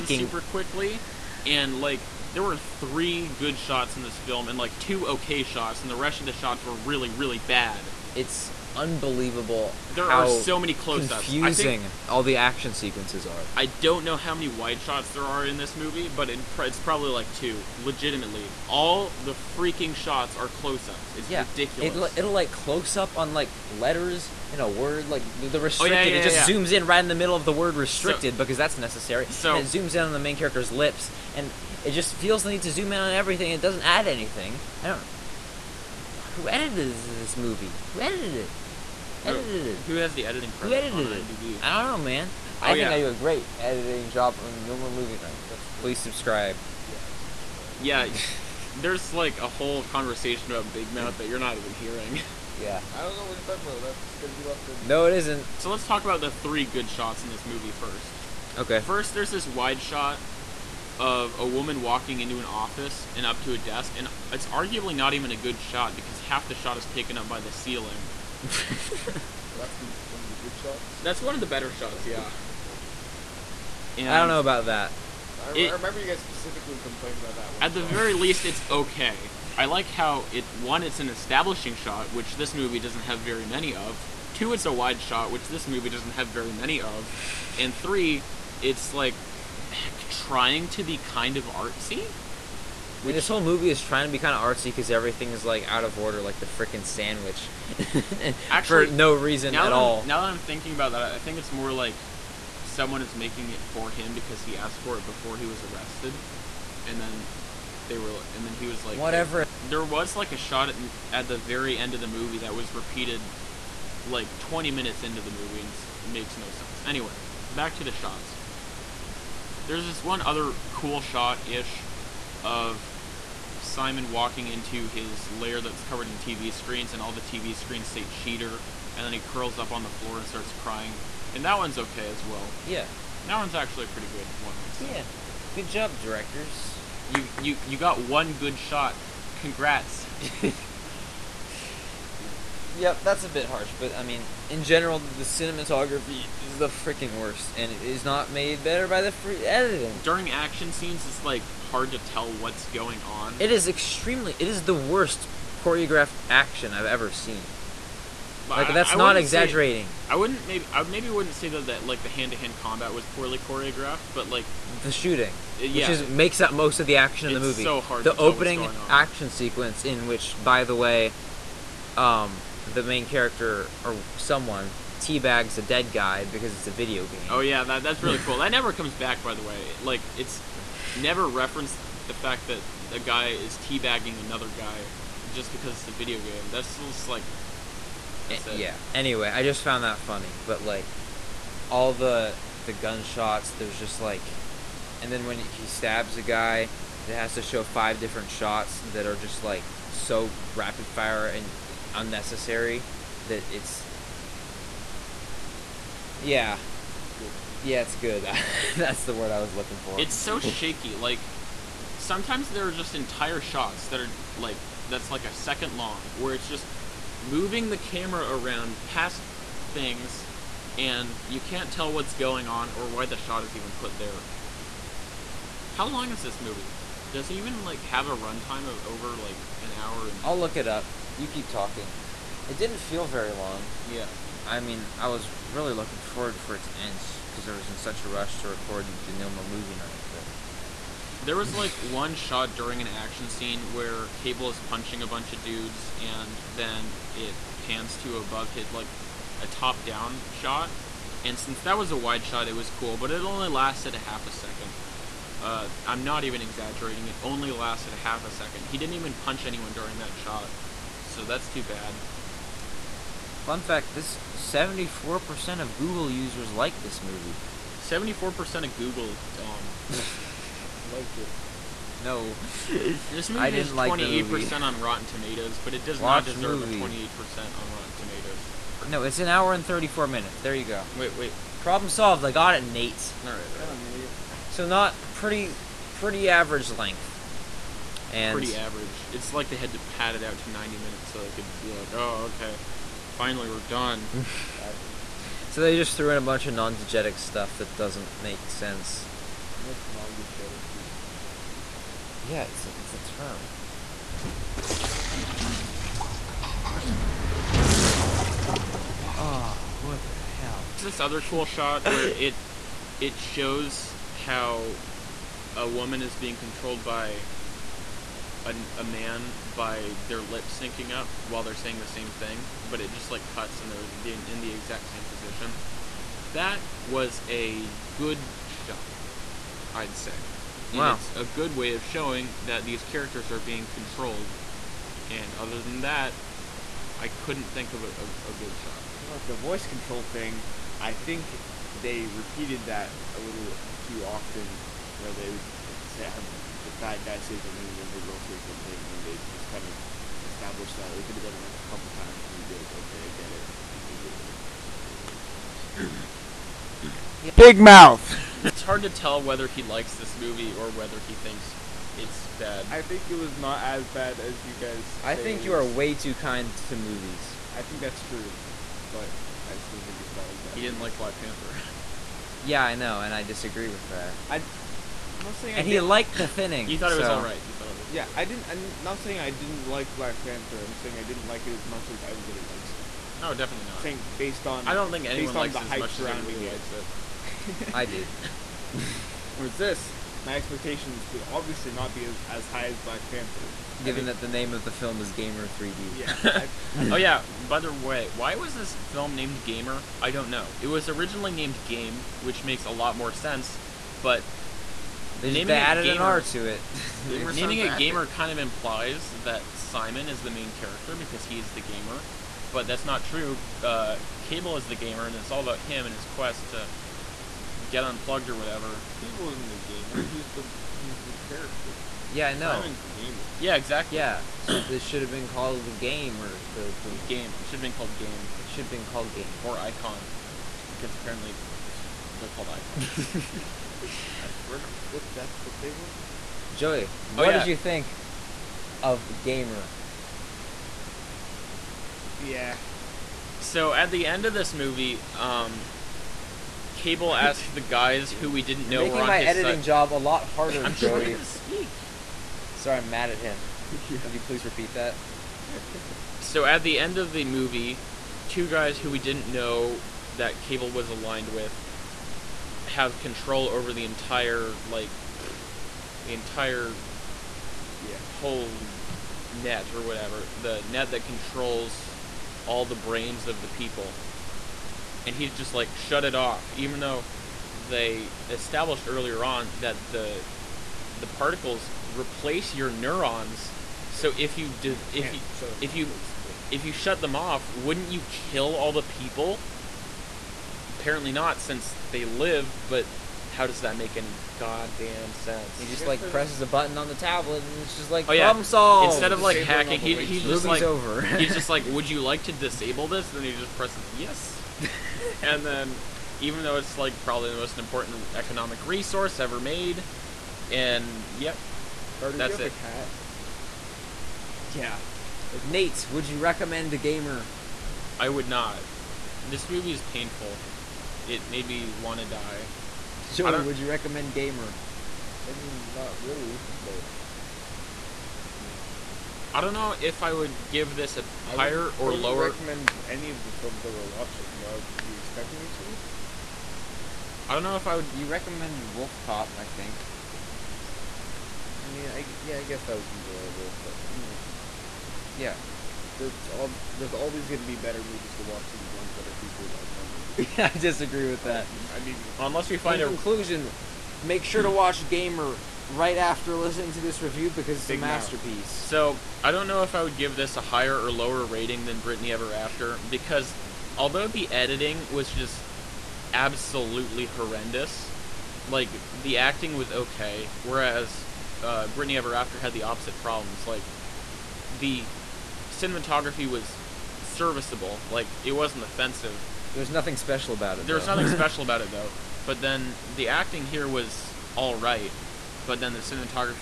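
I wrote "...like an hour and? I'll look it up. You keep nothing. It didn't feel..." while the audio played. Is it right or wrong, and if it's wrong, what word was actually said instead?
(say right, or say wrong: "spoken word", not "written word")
wrong: "talking", not "nothing".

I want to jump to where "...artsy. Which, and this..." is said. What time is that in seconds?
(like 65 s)
91 s.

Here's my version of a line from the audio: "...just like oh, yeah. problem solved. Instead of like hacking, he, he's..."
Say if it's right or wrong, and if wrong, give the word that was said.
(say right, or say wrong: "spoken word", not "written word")
right.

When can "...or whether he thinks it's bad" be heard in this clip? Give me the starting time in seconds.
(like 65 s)
360 s.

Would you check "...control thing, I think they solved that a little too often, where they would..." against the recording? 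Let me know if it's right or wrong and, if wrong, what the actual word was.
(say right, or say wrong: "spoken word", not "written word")
wrong: "repeated", not "solved".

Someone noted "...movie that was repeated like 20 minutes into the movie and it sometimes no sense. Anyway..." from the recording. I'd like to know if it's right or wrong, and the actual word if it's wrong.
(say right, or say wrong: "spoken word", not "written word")
wrong: "makes", not "sometimes".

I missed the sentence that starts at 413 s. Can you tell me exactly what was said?
Uh, Kable is the gamer, and it's all about him and his quest to get unplugged or whatever.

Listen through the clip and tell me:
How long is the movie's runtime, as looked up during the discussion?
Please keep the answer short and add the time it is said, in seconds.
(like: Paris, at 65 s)
1 hour 34 minutes, at 279 s.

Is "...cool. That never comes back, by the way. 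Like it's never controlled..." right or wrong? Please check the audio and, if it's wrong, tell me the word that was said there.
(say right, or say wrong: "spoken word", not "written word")
wrong: "referenced", not "controlled".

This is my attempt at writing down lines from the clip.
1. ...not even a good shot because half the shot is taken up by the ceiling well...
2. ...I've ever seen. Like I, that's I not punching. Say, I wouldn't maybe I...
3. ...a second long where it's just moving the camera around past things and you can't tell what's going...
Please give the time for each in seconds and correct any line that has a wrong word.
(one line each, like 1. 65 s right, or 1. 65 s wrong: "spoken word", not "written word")
1. 64 s right
2. 156 s wrong: "exaggerating", not "punching"
3. 215 s right.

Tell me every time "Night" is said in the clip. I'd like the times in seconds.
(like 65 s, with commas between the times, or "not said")
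45 s, 239 s.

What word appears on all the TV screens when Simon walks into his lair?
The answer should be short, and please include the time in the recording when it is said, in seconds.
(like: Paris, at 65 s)
cheater, at 128 s.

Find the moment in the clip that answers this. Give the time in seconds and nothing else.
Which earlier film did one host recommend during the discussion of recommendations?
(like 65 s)
538 s.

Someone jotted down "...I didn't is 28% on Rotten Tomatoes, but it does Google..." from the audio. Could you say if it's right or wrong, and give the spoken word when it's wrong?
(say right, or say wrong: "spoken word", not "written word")
wrong: "Watch", not "Google".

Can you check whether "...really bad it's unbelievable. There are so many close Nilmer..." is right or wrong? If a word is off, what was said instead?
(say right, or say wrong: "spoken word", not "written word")
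wrong: "Confusing", not "Nilmer".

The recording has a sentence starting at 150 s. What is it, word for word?
During action scenes, it's like hard to tell what's going on.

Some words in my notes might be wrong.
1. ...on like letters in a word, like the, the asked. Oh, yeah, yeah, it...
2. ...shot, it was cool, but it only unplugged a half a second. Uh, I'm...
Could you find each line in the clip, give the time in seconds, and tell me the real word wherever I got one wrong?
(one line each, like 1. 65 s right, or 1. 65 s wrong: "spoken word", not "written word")
1. 23 s wrong: "restricted", not "asked"
2. 252 s wrong: "lasted", not "unplugged".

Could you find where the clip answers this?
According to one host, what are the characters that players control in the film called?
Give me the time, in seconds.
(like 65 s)
432 s.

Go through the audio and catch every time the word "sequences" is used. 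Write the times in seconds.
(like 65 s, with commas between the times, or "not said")
12 s, 169 s.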